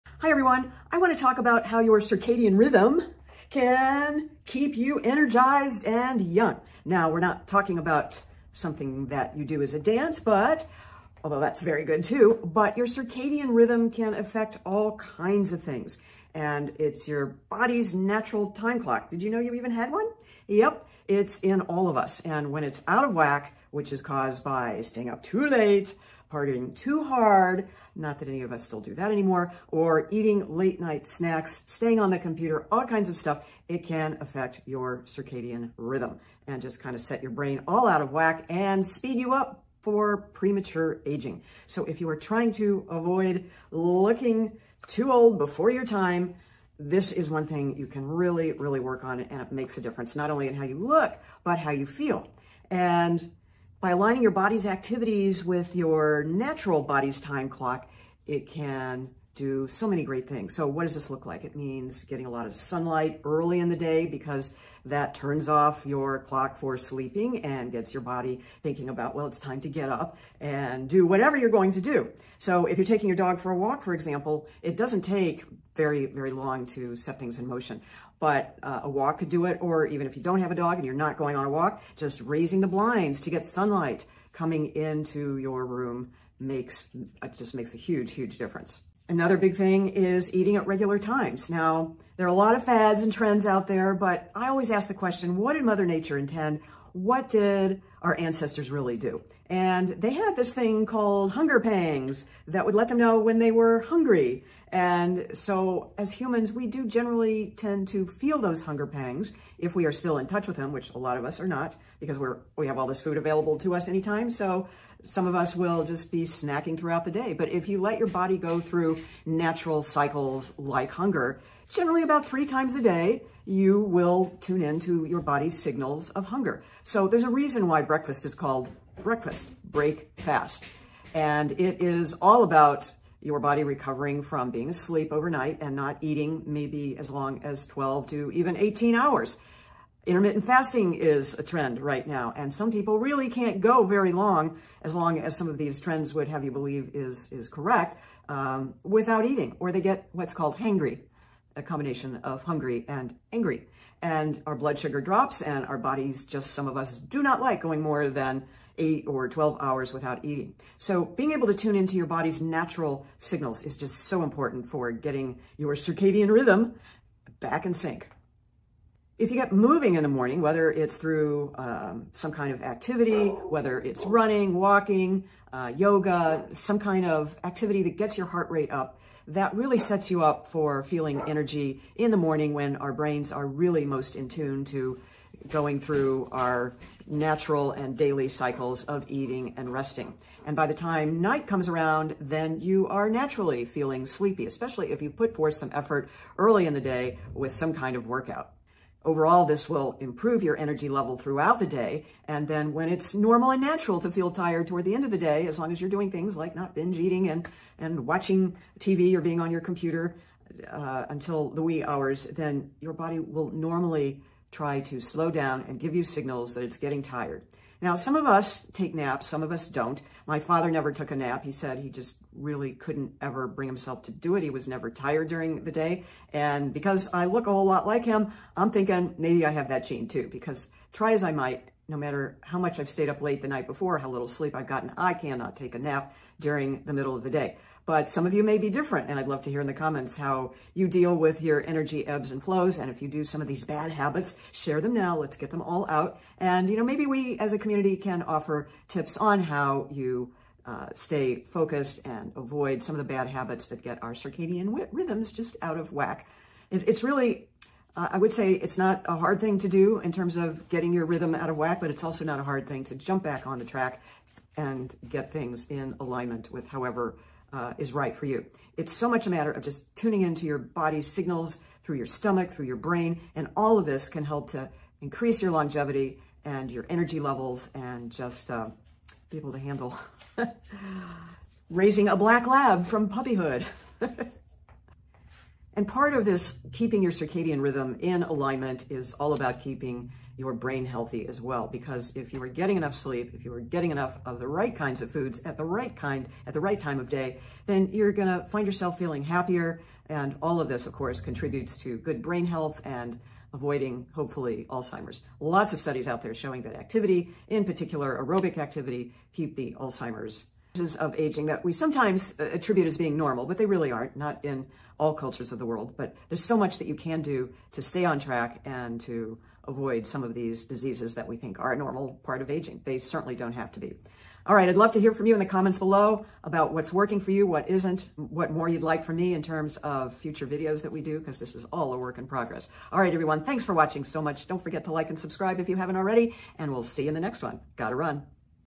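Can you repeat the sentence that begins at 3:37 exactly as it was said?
Now, some of us take naps, some of us don't.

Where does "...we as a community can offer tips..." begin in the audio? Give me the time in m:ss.
4:07.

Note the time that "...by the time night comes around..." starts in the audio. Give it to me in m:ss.
3:10.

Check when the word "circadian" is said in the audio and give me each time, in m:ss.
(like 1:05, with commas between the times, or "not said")
0:01, 0:12, 0:35, 2:45, 4:14, 4:47.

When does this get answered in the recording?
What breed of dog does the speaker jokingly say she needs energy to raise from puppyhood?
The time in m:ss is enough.
4:42.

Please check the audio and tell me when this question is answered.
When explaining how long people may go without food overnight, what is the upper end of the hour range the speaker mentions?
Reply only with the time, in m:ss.
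2:18.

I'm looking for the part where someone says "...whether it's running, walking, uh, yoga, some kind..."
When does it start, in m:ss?
2:53.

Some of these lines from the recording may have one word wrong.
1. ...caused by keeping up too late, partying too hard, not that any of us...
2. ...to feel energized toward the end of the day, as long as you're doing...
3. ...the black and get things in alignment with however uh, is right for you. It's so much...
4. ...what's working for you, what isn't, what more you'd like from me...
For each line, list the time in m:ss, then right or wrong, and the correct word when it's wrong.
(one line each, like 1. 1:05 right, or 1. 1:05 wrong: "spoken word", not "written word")
1. 0:24 wrong: "staying", not "keeping"
2. 3:24 wrong: "tired", not "energized"
3. 4:23 wrong: "track", not "black"
4. 5:26 right.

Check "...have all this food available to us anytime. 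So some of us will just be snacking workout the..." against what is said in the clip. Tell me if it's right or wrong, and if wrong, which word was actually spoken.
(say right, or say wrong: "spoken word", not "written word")
wrong: "throughout", not "workout".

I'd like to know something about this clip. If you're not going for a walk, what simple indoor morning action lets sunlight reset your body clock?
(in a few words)
Raising the blinds.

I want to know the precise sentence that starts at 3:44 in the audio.
He was never tired during the day.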